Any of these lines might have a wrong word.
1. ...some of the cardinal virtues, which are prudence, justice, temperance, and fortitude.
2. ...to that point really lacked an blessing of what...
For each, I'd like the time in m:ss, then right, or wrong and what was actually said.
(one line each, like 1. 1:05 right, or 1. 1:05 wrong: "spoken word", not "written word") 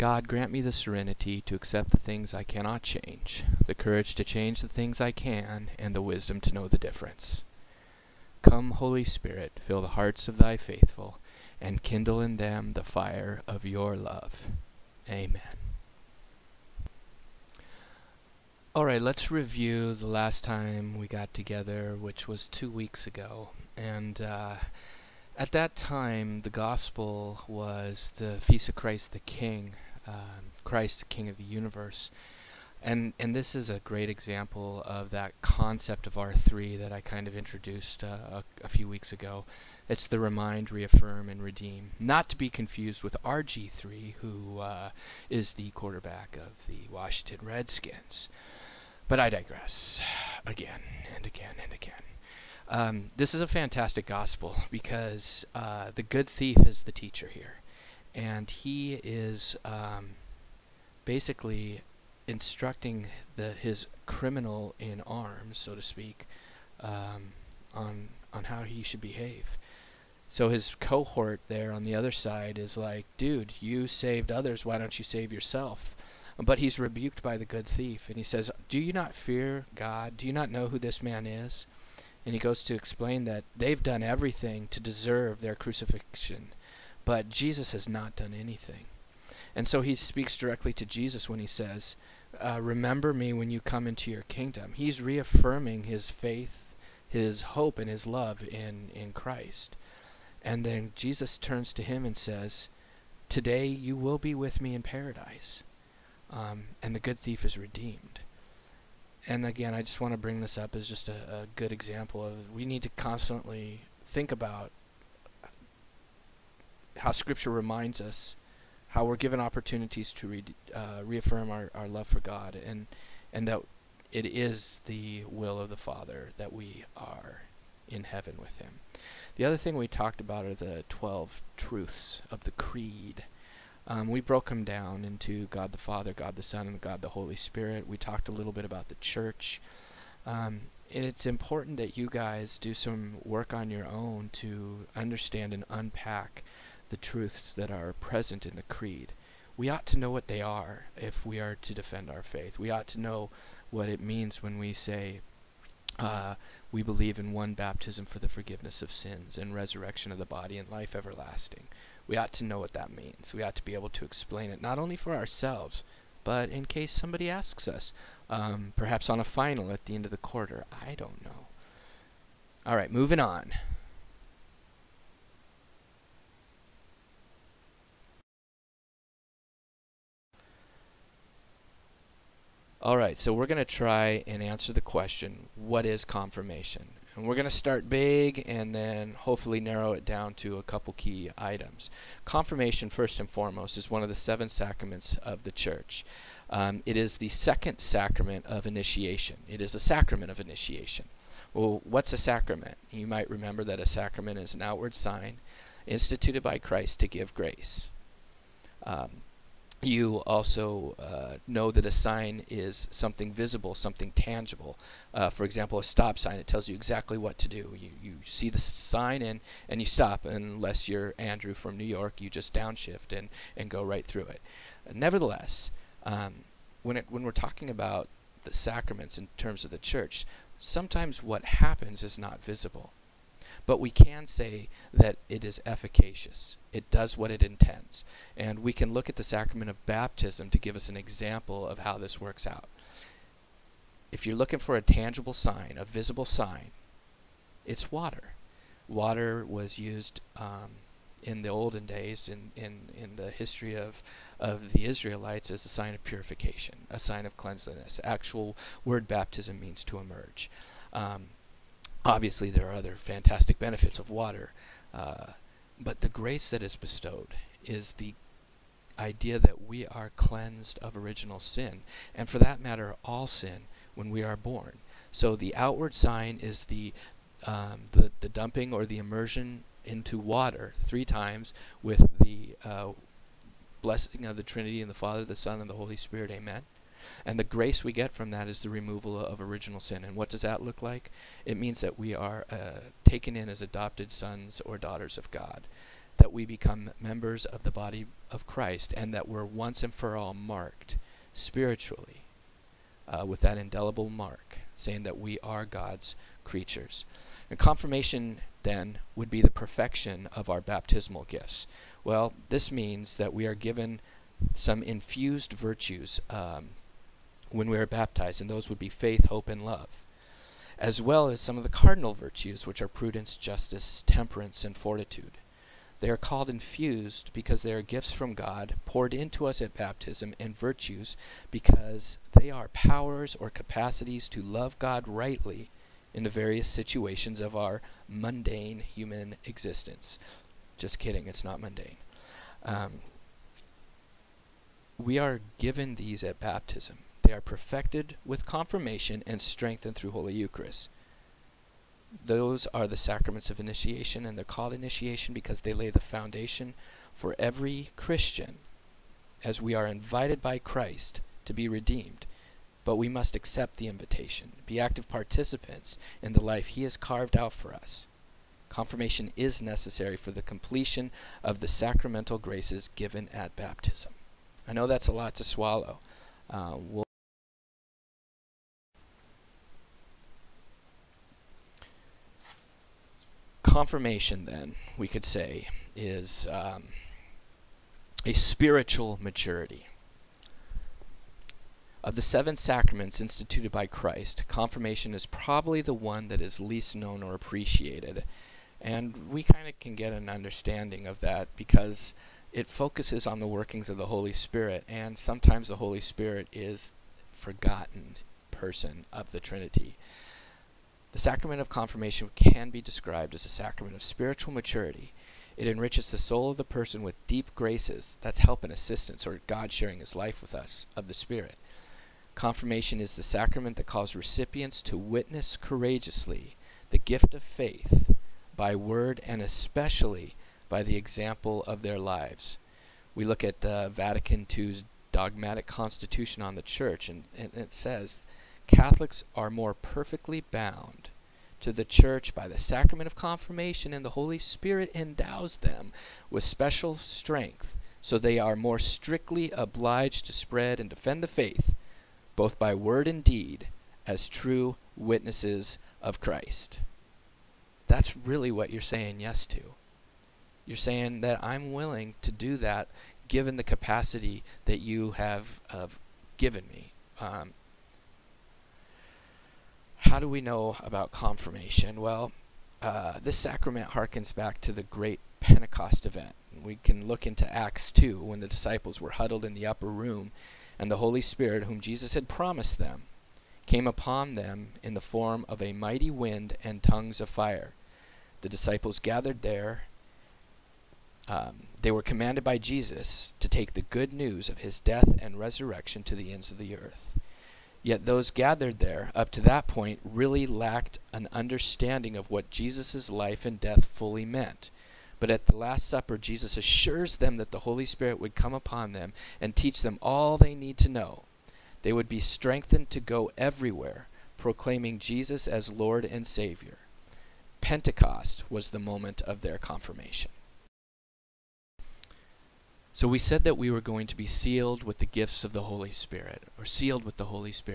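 1. 5:21 right
2. 8:19 wrong: "understanding", not "blessing".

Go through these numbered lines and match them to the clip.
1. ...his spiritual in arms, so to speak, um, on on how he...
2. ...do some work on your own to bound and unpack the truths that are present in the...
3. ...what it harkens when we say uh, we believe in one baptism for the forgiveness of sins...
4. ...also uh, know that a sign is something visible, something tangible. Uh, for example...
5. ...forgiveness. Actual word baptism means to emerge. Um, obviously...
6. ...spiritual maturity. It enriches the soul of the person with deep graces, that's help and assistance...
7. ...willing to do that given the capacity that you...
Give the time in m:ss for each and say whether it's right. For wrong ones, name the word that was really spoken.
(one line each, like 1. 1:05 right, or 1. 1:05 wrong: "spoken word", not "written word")
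1. 1:03 wrong: "criminal", not "spiritual"
2. 2:22 wrong: "understand", not "bound"
3. 2:33 wrong: "means", not "harkens"
4. 3:30 right
5. 4:17 wrong: "cleanliness", not "forgiveness"
6. 6:54 right
7. 7:41 right.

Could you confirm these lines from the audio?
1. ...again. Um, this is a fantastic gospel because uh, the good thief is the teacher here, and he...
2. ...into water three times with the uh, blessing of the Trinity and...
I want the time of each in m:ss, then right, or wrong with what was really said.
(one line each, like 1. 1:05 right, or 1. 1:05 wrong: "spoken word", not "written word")
1. 0:51 right
2. 4:39 right.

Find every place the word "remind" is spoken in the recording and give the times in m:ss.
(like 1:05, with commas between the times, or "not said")
0:40, 1:57.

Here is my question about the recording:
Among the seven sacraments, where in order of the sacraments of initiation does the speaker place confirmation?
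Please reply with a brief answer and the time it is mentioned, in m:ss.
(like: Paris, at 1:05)
second, at 3:17.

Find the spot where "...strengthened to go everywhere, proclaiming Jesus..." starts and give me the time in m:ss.
8:32.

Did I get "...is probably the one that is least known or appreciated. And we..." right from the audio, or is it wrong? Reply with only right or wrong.
right.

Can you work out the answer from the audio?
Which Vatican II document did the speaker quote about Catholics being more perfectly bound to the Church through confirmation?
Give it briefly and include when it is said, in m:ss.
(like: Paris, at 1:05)
dogmatic constitution on the church, at 7:15.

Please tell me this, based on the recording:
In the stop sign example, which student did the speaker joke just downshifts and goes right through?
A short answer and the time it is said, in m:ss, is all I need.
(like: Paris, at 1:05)
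Andrew from New York, at 3:41.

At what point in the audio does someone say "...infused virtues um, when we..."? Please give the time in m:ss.
5:14.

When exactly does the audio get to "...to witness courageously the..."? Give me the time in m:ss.
7:04.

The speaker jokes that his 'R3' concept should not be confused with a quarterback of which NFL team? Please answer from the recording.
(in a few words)
Washington Redskins.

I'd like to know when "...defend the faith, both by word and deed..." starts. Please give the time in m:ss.
7:30.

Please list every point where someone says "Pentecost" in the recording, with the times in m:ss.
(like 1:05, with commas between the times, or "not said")
7:55, 8:37.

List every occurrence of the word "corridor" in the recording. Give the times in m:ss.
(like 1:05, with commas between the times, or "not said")
not said.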